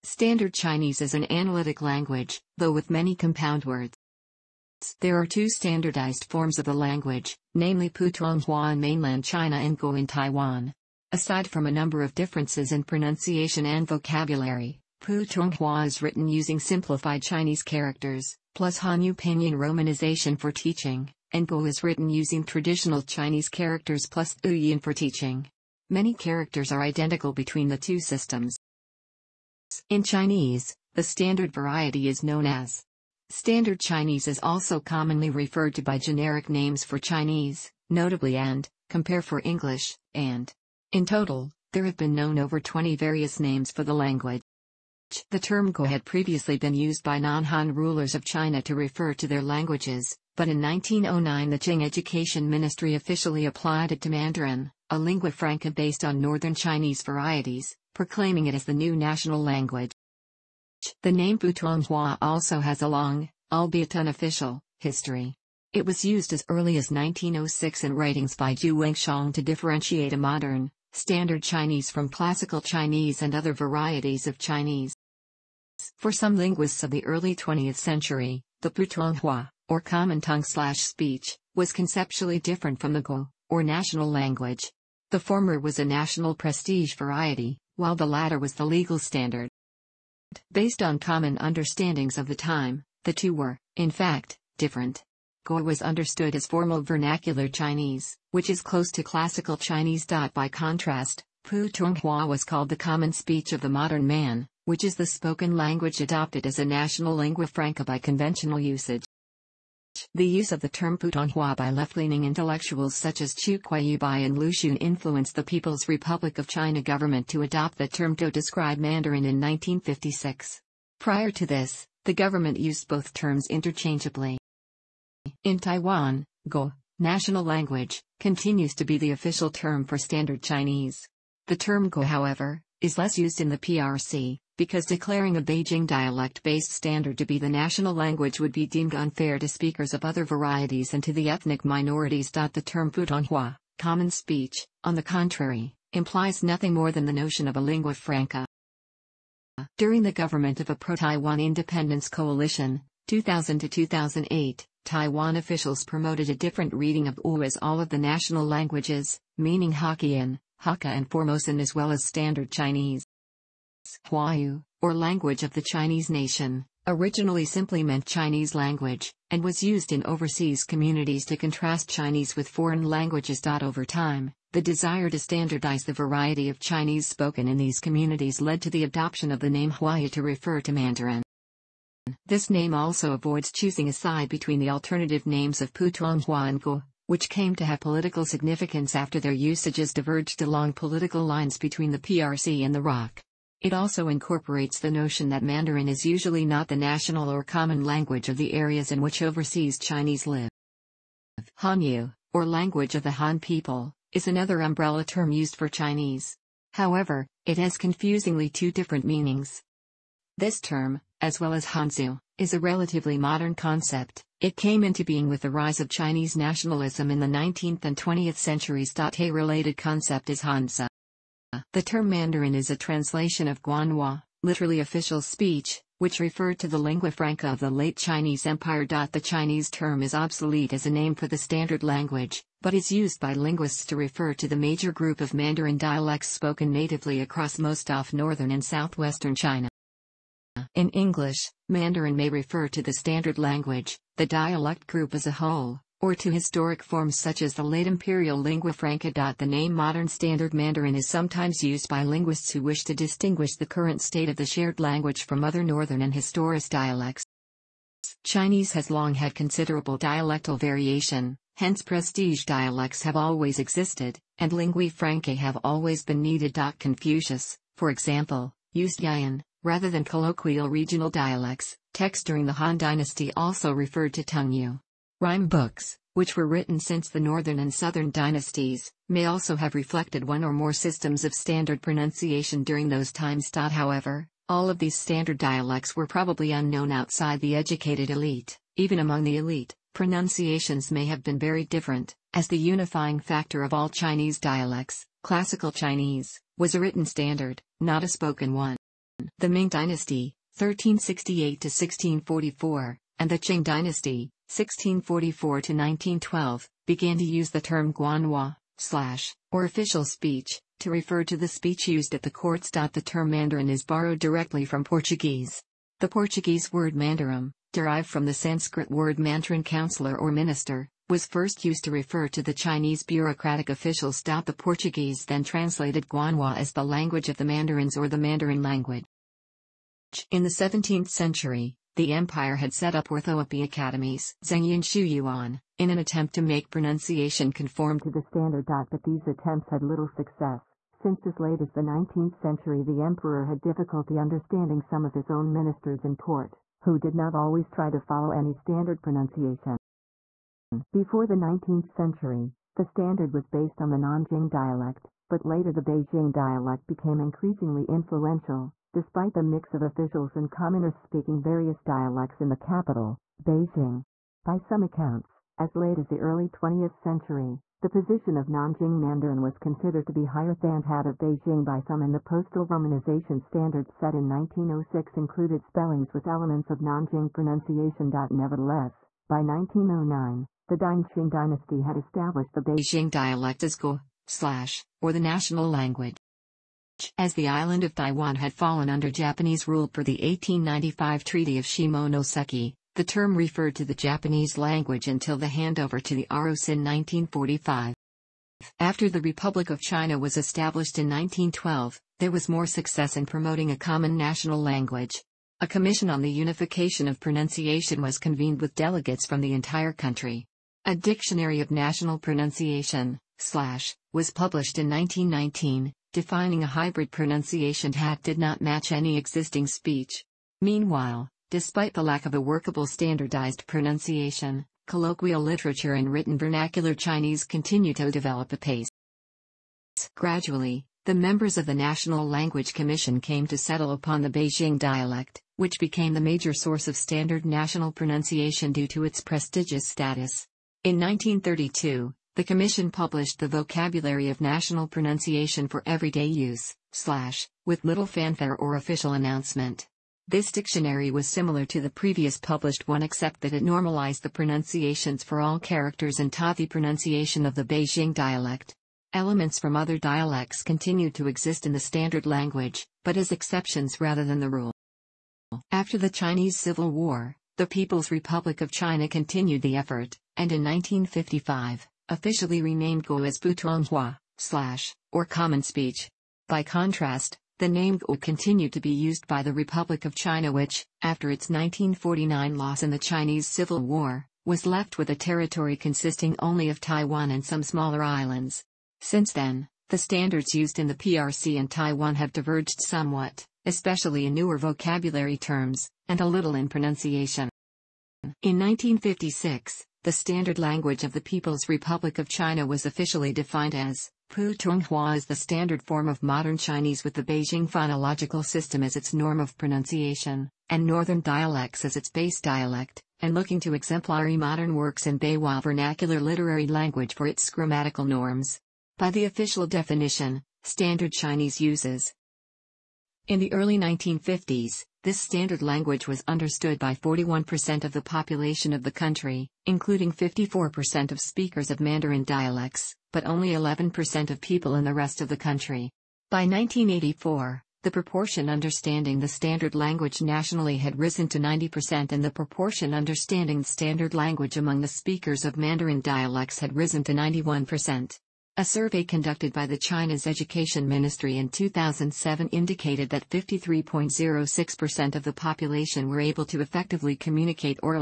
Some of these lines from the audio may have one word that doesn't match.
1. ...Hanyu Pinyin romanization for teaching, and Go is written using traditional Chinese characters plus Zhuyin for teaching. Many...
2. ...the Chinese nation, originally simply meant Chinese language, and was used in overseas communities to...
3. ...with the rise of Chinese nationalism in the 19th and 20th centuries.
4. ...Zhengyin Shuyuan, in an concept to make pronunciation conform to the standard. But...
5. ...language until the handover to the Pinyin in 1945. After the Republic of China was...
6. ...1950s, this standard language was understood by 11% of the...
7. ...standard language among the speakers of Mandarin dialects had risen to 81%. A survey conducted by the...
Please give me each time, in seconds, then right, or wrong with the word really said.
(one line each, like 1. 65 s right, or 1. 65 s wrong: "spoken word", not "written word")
1. 18 s right
2. 165 s right
3. 215 s right
4. 334 s wrong: "attempt", not "concept"
5. 394 s wrong: "ROC", not "Pinyin"
6. 523 s wrong: "41", not "11"
7. 543 s wrong: "91", not "81".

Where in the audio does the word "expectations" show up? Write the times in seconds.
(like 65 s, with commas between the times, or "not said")
not said.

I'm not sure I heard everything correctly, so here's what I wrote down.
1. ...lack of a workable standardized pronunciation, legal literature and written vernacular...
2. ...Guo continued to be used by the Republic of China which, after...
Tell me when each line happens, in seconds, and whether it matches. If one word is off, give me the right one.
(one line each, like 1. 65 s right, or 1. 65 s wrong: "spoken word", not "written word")
1. 422 s wrong: "colloquial", not "legal"
2. 477 s right.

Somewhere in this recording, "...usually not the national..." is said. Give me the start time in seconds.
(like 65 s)
196 s.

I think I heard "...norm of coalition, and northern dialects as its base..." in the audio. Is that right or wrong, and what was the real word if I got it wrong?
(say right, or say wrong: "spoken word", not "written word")
wrong: "pronunciation", not "coalition".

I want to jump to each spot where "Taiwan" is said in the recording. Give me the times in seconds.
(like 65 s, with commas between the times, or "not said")
10 s, 125 s, 150 s, 154 s, 387 s, 486 s, 491 s.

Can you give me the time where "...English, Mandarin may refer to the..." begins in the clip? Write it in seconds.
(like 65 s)
240 s.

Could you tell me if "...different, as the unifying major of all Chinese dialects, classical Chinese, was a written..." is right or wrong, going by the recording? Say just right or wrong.
wrong.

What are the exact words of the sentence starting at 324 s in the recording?
The Portuguese then translated Guanhua as the language of the Mandarins or the Mandarin language.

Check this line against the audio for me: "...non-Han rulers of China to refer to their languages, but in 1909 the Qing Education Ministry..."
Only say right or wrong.
right.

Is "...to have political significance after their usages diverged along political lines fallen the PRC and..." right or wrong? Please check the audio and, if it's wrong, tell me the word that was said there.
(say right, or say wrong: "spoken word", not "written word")
wrong: "between", not "fallen".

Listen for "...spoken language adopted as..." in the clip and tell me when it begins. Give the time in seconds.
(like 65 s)
105 s.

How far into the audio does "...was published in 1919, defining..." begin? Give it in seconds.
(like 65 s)
414 s.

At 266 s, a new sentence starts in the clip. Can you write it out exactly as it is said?
Confucius, for example, used Yan rather than colloquial regional dialects.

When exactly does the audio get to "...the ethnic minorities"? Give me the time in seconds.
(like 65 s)
141 s.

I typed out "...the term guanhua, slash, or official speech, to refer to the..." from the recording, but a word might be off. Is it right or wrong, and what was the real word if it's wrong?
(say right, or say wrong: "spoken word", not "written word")
right.